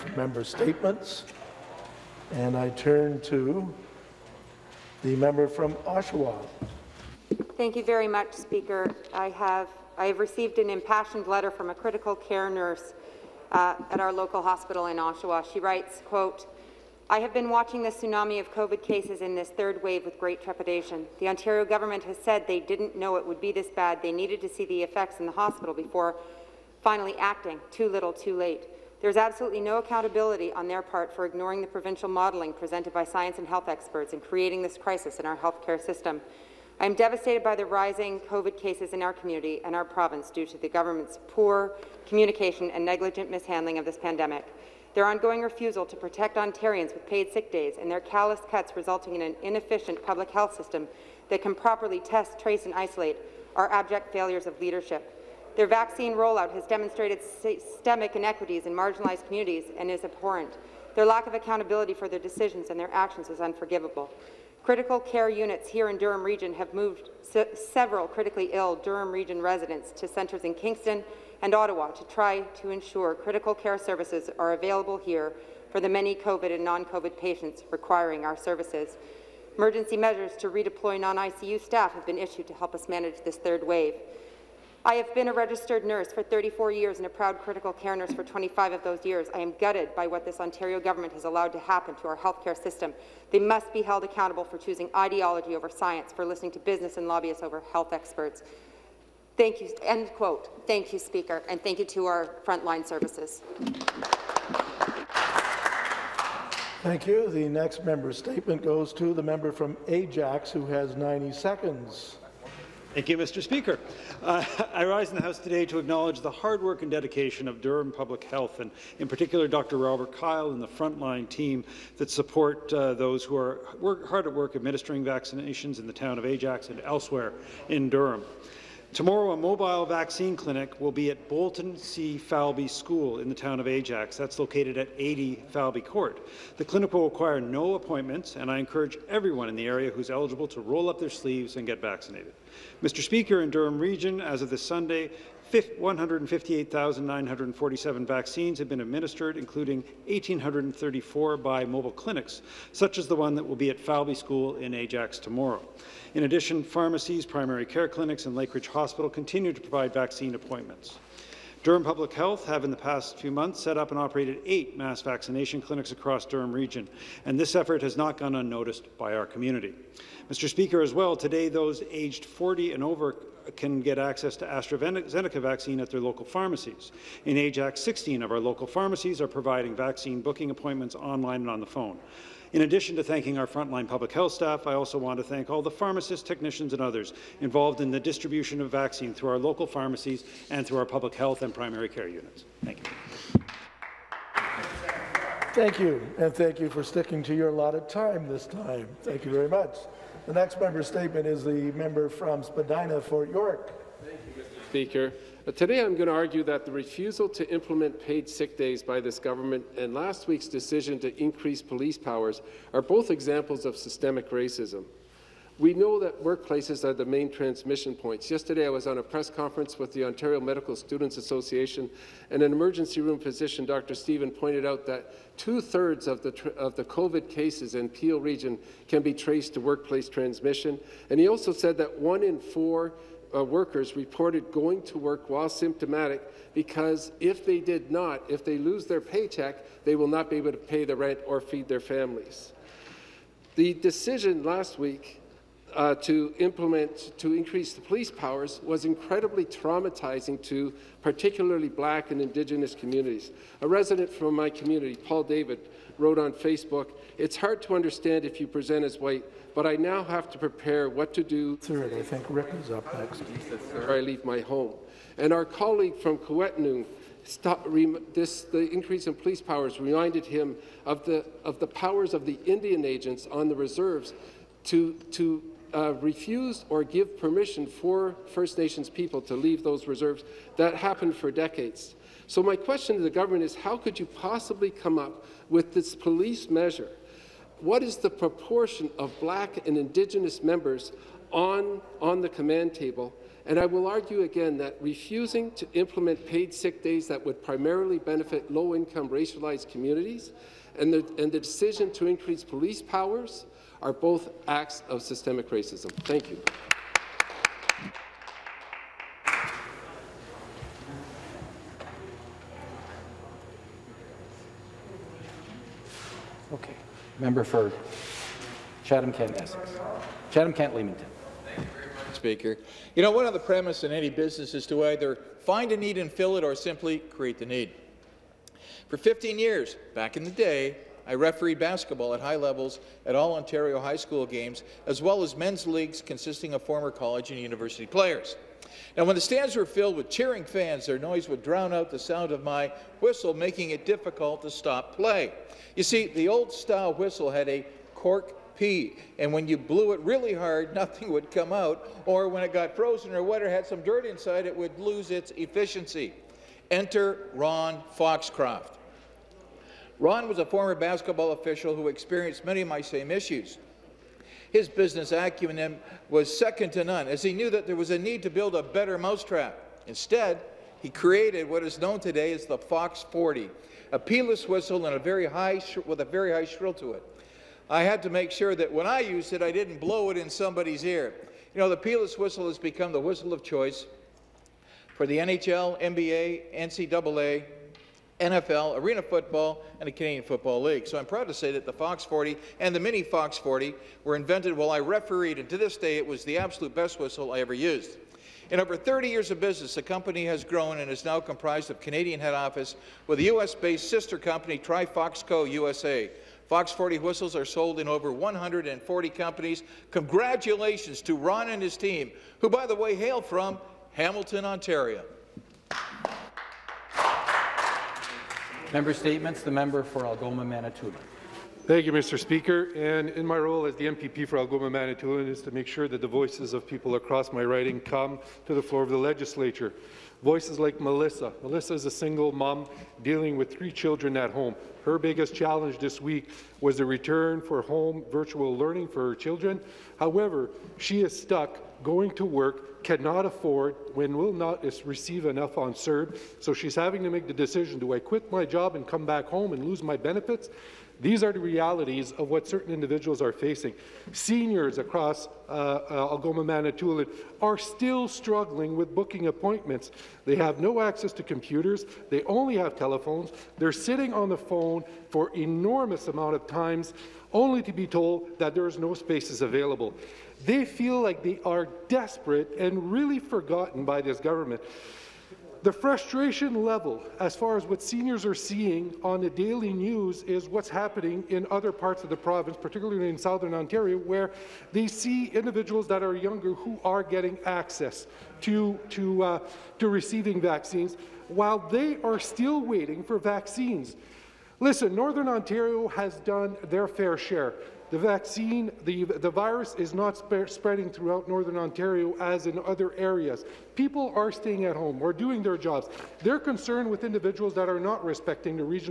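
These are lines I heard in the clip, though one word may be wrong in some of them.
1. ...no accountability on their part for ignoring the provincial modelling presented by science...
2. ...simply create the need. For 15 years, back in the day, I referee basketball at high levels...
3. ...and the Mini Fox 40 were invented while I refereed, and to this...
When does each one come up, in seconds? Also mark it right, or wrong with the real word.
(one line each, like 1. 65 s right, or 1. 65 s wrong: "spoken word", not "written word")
1. 29 s right
2. 326 s right
3. 392 s right.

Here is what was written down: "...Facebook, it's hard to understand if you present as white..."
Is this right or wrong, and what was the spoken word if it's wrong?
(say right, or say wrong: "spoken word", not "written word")
right.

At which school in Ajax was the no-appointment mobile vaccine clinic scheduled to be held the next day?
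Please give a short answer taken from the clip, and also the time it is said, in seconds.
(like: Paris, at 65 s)
Bolton C. Falby School, at 131 s.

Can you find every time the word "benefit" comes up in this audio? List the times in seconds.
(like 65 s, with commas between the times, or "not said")
297 s, 449 s.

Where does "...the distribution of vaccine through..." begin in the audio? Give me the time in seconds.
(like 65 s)
187 s.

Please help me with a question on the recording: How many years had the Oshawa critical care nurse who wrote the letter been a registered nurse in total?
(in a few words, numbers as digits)
34.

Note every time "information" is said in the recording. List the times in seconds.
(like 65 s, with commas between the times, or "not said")
not said.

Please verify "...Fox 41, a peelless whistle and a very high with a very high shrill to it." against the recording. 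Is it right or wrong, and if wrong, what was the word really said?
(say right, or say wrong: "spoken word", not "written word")
wrong: "40", not "41".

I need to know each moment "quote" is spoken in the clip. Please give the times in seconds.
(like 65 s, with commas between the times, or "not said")
16 s, 100 s.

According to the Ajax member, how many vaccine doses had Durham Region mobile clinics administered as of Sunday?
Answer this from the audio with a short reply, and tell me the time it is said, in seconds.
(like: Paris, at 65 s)
1,834, at 150 s.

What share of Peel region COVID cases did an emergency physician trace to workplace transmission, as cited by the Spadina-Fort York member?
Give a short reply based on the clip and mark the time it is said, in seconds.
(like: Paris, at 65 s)
two-thirds, at 225 s.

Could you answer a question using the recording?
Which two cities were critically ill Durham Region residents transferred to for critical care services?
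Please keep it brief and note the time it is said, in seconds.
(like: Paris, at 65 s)
Kingston and Ottawa, at 70 s.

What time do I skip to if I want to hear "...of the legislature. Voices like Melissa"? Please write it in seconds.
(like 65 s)
428 s.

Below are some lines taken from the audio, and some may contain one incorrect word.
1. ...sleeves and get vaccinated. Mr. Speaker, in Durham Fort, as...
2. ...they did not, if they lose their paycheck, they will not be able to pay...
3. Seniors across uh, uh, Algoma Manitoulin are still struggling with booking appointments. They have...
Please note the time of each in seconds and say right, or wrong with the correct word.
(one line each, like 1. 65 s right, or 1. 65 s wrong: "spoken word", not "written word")
1. 141 s wrong: "Region", not "Fort"
2. 237 s right
3. 454 s right.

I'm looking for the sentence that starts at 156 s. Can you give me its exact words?
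In addition, pharmacies, primary care clinics, and Lakeridge Hospital continue to provide vaccine appointments.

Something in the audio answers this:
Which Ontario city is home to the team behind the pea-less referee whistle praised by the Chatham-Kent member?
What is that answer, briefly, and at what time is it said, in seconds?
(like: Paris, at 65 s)
Hamilton, at 413 s.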